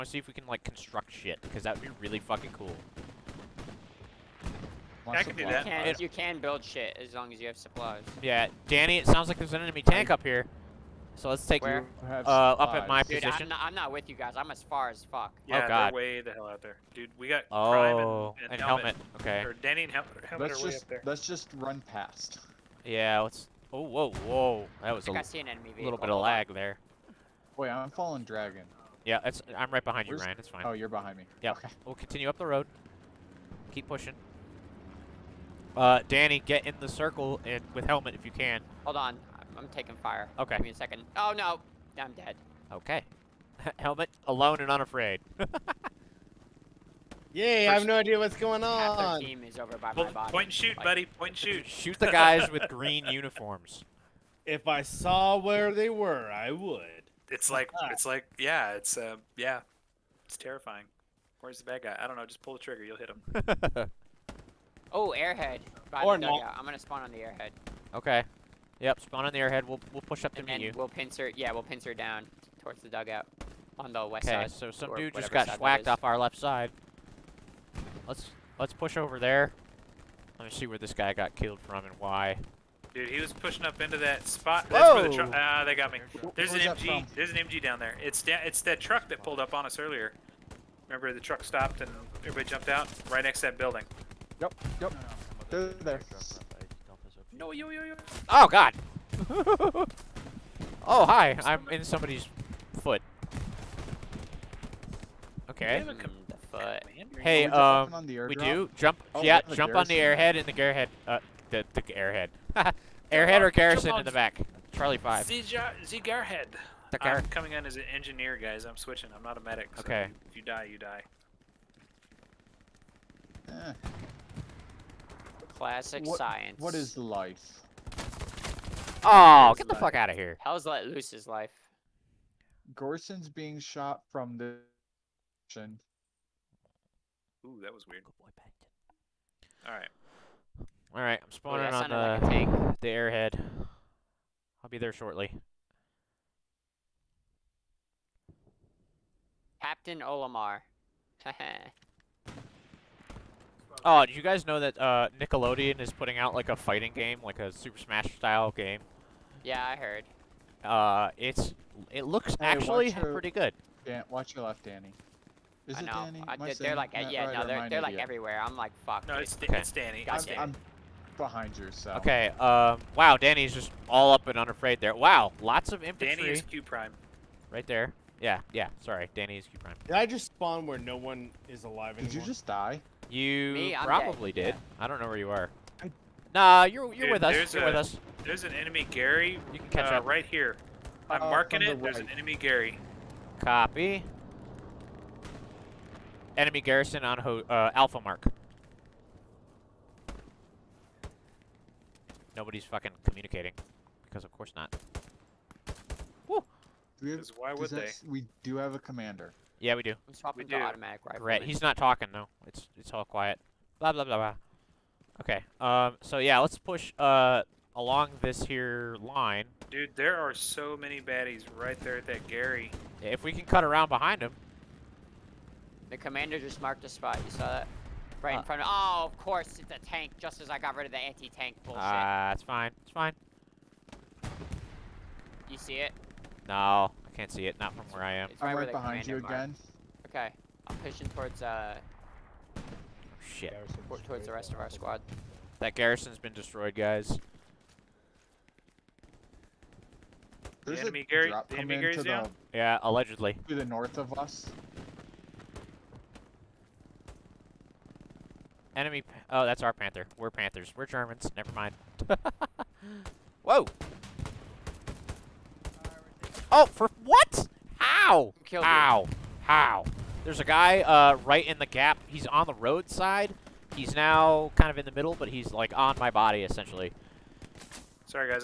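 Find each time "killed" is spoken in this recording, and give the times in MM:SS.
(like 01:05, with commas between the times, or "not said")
01:21, 04:28.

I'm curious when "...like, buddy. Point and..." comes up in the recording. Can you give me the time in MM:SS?
00:50.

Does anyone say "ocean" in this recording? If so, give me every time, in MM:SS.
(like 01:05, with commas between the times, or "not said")
not said.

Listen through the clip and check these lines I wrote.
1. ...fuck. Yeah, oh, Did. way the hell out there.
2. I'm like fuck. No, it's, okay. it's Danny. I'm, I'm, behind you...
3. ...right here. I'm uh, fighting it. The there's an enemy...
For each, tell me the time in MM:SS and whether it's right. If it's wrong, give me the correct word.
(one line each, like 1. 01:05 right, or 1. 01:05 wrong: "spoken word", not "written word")
1. 00:15 wrong: "God", not "Did"
2. 02:48 right
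3. 03:10 wrong: "marking", not "fighting".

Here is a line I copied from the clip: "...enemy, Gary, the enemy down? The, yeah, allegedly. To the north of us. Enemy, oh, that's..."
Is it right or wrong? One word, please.
right.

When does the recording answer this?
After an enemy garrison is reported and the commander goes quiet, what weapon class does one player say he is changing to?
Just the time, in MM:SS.
03:30.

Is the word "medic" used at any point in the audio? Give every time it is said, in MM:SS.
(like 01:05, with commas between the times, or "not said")
01:59.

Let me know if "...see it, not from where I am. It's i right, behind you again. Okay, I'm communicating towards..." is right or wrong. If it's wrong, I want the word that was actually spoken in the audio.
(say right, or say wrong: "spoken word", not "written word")
wrong: "pushing", not "communicating".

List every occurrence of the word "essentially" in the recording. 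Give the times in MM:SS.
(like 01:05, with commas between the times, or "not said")
04:36.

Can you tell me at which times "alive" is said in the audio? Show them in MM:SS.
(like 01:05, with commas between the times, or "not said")
03:01.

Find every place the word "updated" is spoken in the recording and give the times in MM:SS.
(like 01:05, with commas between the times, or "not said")
not said.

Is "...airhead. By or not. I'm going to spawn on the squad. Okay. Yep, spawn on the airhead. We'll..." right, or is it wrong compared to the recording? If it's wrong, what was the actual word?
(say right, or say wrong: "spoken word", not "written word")
wrong: "airhead", not "squad".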